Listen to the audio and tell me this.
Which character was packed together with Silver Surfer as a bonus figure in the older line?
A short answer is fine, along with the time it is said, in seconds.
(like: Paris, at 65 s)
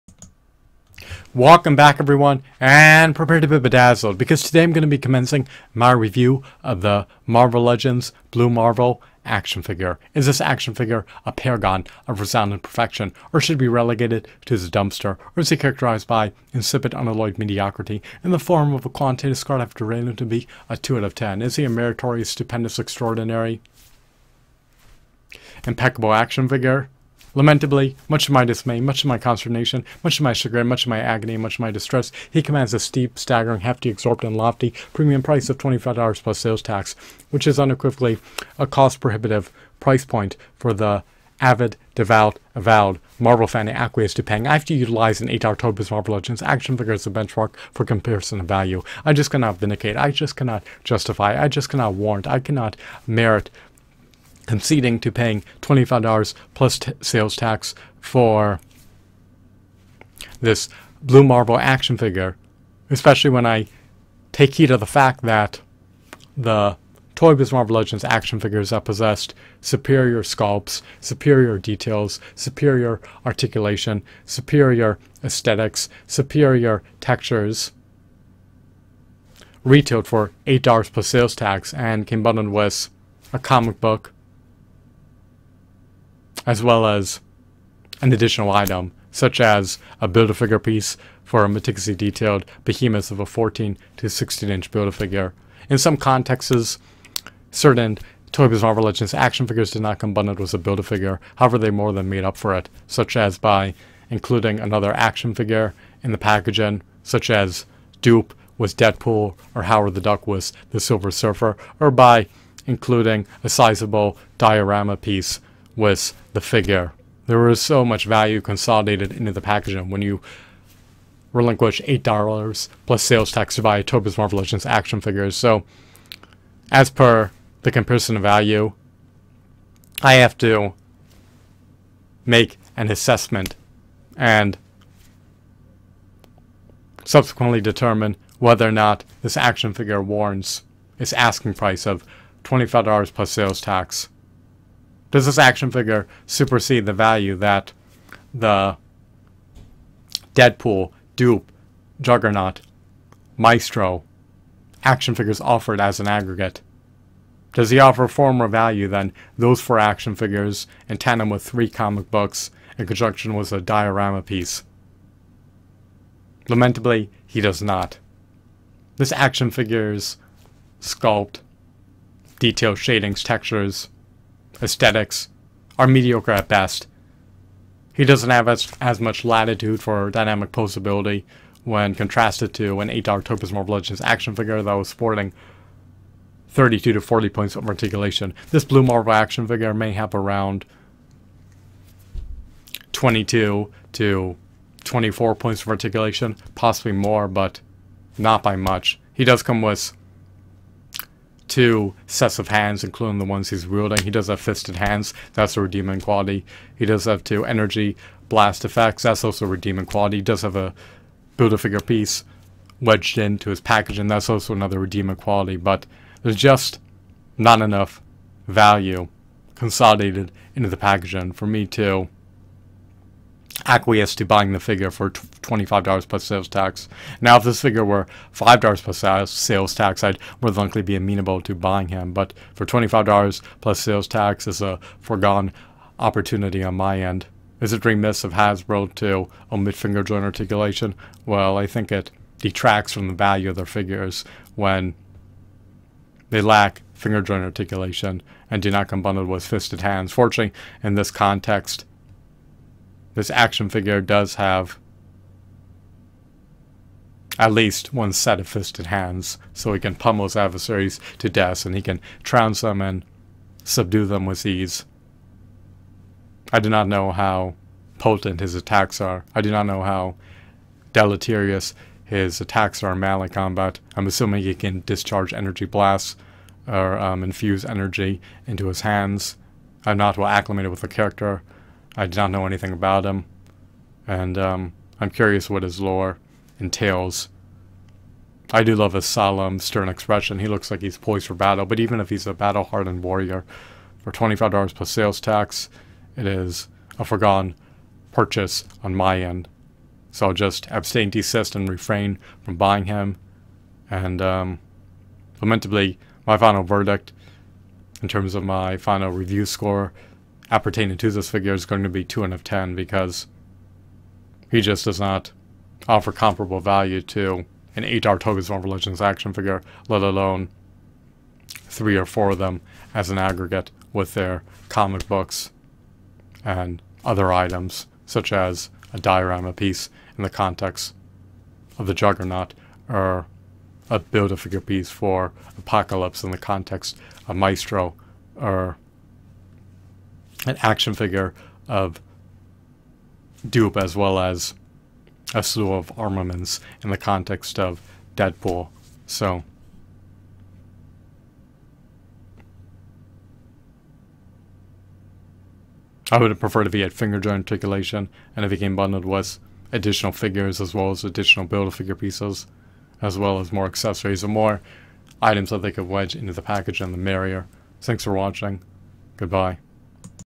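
Howard the Duck, at 109 s.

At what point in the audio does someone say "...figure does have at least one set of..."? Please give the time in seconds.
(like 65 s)
253 s.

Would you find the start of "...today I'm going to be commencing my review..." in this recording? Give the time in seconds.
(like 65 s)
4 s.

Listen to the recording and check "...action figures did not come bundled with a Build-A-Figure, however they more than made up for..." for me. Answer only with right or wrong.
right.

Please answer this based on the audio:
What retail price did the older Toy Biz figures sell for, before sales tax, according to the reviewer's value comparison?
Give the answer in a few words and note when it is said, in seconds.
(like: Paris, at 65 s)
$8, at 79 s.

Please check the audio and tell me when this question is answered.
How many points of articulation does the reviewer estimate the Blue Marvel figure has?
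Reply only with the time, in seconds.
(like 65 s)
192 s.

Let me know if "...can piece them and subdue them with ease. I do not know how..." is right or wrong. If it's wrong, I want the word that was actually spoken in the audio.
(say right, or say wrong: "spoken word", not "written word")
wrong: "trounce", not "piece".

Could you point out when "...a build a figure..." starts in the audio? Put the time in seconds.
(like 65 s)
210 s.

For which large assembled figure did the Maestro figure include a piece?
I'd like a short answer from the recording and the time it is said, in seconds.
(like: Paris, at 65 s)
Apocalypse, at 335 s.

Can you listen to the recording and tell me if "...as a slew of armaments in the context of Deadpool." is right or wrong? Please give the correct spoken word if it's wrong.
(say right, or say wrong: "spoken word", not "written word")
right.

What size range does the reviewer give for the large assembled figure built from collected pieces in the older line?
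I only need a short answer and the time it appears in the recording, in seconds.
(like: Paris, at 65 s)
14 to 16 inch, at 93 s.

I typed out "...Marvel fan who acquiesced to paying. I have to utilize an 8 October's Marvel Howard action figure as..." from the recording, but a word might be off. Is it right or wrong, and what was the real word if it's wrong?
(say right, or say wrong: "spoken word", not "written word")
wrong: "Legends", not "Howard".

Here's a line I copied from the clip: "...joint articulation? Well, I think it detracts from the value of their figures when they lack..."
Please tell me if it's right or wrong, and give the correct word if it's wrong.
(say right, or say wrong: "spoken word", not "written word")
right.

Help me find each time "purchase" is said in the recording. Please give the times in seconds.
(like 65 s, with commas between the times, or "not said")
298 s.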